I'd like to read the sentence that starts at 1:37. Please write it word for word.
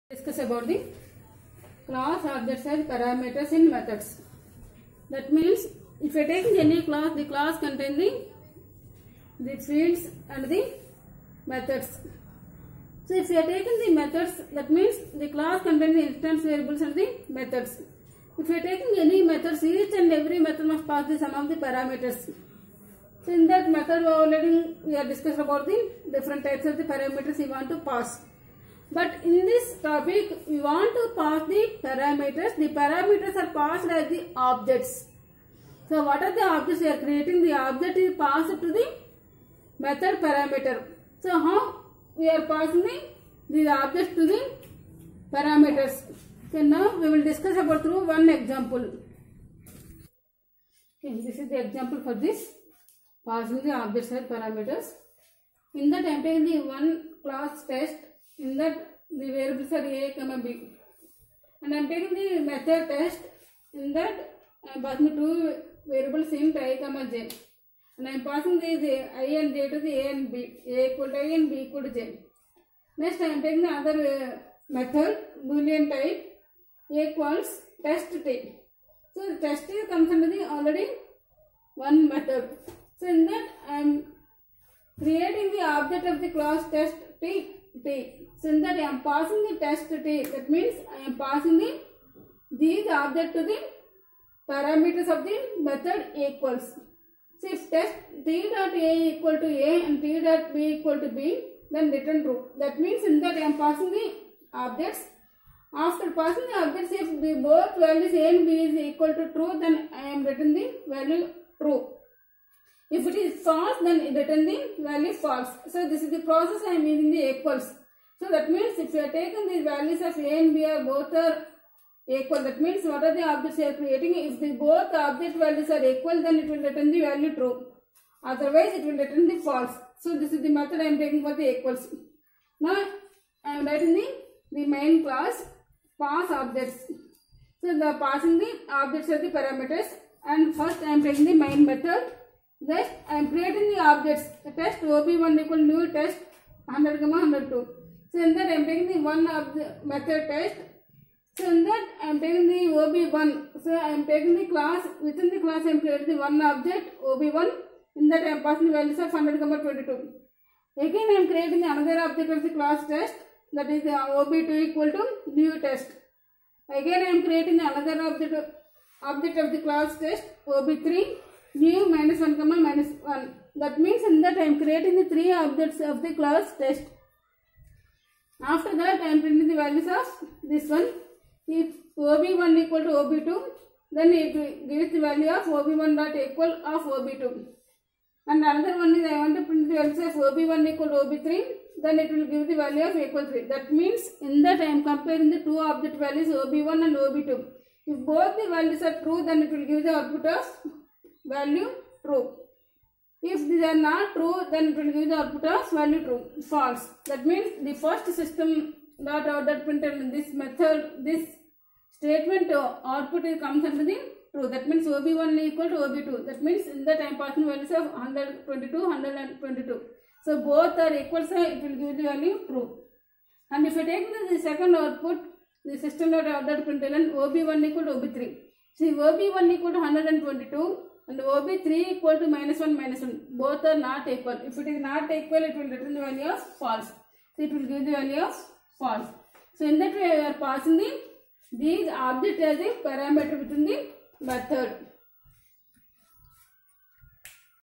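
So if test t dot a equal to a and t dot b equal to b, then return true.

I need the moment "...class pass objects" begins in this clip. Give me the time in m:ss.
2:15.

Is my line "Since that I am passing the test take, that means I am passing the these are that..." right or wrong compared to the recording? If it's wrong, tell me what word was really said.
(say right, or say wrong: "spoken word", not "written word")
right.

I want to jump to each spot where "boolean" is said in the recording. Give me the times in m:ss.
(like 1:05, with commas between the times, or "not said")
1:15.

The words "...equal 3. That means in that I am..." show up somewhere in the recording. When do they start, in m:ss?
3:12.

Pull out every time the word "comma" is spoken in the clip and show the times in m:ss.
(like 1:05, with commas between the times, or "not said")
1:00, 1:06, 2:52.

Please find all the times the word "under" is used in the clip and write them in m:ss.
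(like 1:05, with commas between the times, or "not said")
1:20, 3:33.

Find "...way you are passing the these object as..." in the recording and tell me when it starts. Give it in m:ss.
3:59.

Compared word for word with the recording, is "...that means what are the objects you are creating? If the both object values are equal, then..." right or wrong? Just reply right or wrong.
right.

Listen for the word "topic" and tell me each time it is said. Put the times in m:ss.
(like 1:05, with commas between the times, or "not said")
0:29.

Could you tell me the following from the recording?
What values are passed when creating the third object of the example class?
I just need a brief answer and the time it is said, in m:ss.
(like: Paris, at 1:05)
-1, -1, at 2:51.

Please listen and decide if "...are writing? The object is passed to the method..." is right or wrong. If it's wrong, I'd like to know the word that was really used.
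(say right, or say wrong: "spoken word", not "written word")
wrong: "creating", not "writing".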